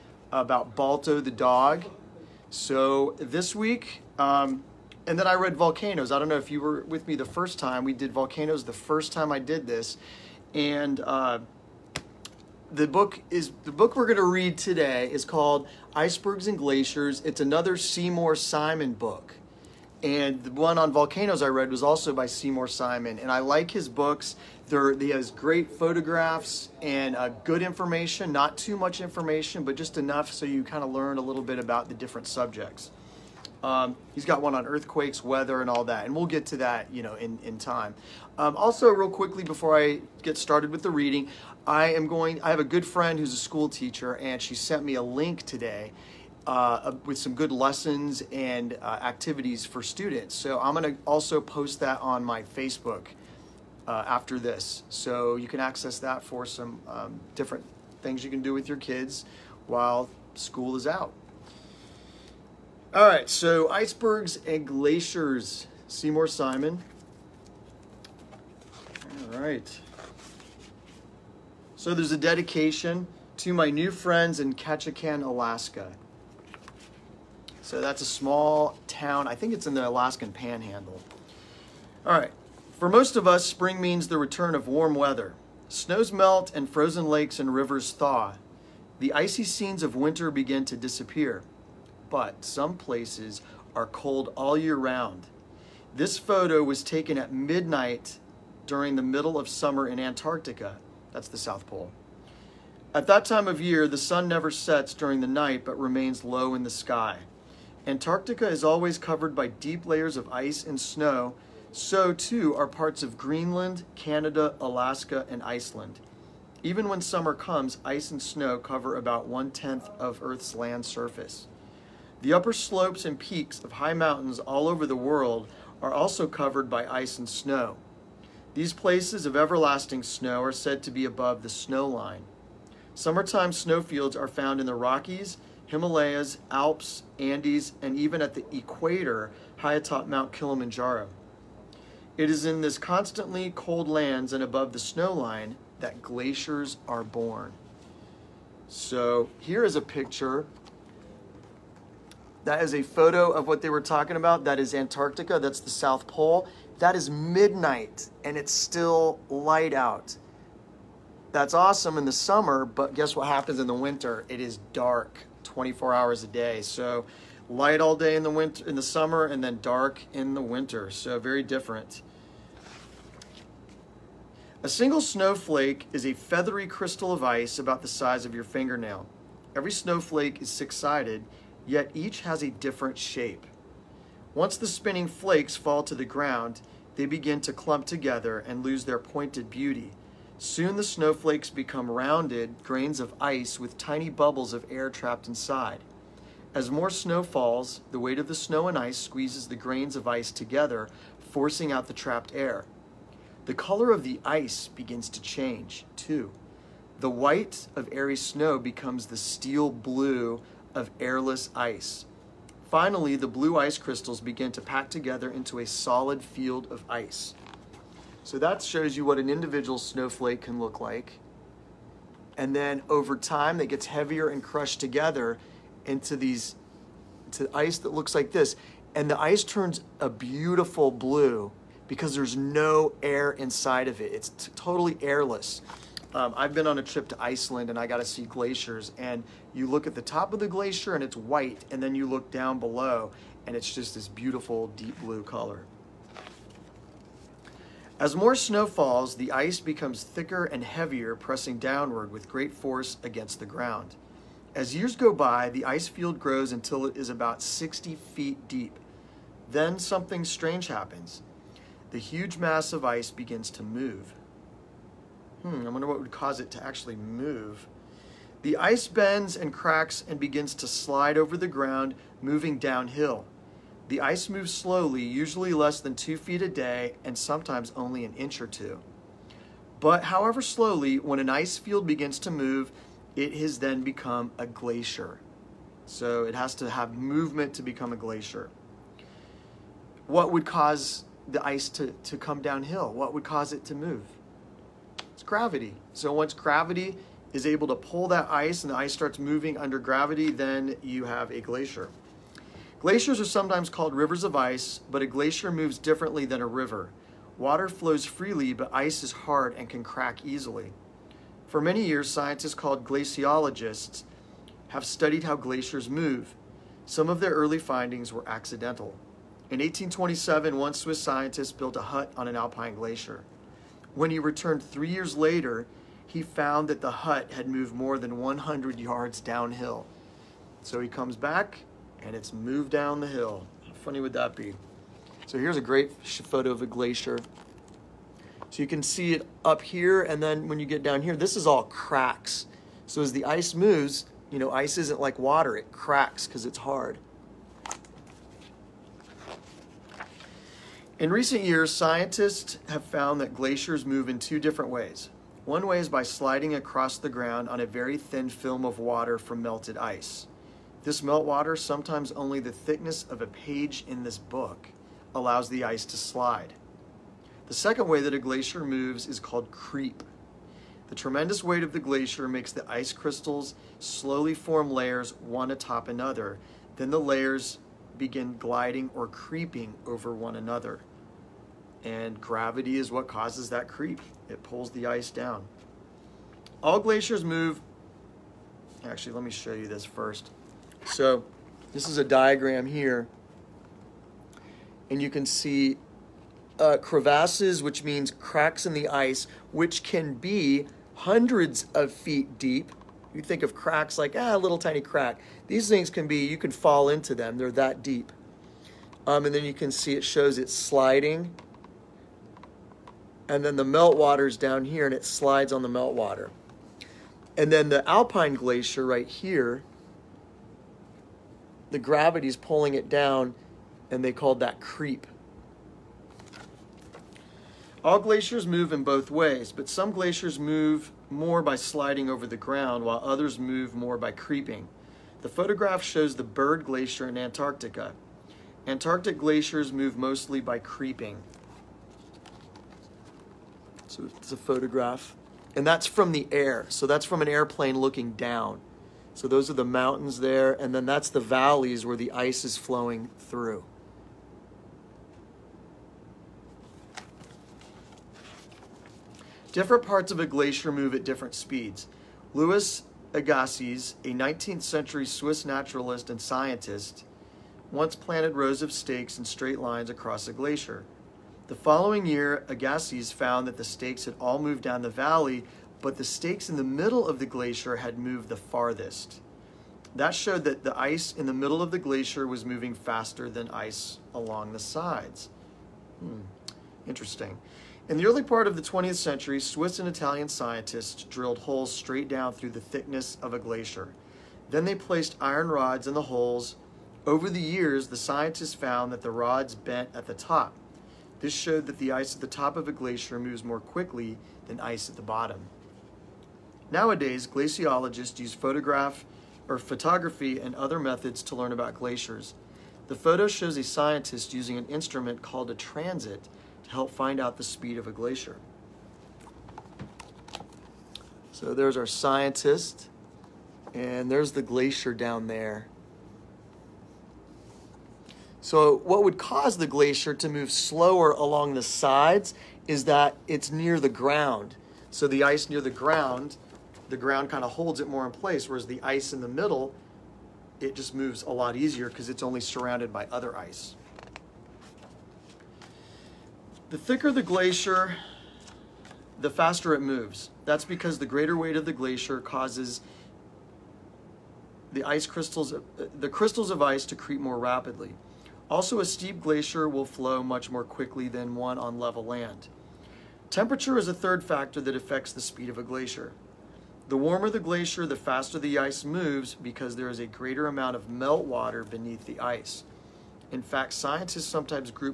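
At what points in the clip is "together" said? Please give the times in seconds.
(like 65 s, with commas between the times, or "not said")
187 s, 200 s, 214 s, 224 s.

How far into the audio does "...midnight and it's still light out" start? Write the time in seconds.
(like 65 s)
157 s.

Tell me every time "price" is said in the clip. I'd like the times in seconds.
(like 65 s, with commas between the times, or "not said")
not said.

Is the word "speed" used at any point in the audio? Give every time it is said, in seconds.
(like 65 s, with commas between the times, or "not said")
461 s, 517 s, 565 s.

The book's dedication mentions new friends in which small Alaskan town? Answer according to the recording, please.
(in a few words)
Ketchikan.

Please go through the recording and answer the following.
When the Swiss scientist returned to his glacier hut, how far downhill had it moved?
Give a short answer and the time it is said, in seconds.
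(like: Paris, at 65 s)
more than 100 yards, at 327 s.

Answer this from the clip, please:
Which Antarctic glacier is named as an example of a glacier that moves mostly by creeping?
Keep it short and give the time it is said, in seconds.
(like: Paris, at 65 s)
Byrd Glacier, at 436 s.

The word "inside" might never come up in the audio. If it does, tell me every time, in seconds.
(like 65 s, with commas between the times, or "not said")
195 s, 233 s.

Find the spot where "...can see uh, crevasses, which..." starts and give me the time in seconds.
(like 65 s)
395 s.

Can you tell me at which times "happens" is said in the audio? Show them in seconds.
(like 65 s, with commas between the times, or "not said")
163 s, 260 s.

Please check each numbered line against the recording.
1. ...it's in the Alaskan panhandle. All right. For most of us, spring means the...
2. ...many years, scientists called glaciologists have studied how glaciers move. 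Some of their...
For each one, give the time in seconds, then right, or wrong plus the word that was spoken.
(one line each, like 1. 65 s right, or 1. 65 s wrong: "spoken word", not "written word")
1. 79 s right
2. 311 s right.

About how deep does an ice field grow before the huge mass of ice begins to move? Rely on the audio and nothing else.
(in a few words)
60 feet.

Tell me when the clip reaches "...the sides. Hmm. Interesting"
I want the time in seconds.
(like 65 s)
484 s.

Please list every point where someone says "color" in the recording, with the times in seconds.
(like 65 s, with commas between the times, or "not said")
203 s, 245 s.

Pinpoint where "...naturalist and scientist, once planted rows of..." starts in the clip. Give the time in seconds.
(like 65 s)
465 s.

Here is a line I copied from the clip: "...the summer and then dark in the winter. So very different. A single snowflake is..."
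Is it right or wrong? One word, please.
right.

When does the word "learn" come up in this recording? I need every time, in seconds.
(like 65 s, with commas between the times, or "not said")
30 s, 511 s.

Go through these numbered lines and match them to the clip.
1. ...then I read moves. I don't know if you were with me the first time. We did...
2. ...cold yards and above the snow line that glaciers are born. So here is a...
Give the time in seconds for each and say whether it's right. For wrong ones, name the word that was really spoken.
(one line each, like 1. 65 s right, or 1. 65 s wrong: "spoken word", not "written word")
1. 5 s wrong: "volcanoes", not "moves"
2. 143 s wrong: "lands", not "yards".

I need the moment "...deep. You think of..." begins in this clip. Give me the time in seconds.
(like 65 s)
402 s.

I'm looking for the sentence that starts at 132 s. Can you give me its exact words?
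Summertime snowfields are found in the Rockies, Himalayas, Alps, Andes, and even at the equator, high atop Mount Kilimanjaro.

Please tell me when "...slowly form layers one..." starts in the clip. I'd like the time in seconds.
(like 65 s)
373 s.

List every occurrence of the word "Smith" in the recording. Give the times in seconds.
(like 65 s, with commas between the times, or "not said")
not said.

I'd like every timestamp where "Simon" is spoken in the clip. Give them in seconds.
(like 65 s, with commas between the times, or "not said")
18 s, 22 s, 66 s.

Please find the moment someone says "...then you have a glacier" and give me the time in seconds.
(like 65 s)
300 s.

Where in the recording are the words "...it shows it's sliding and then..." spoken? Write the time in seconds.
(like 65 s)
409 s.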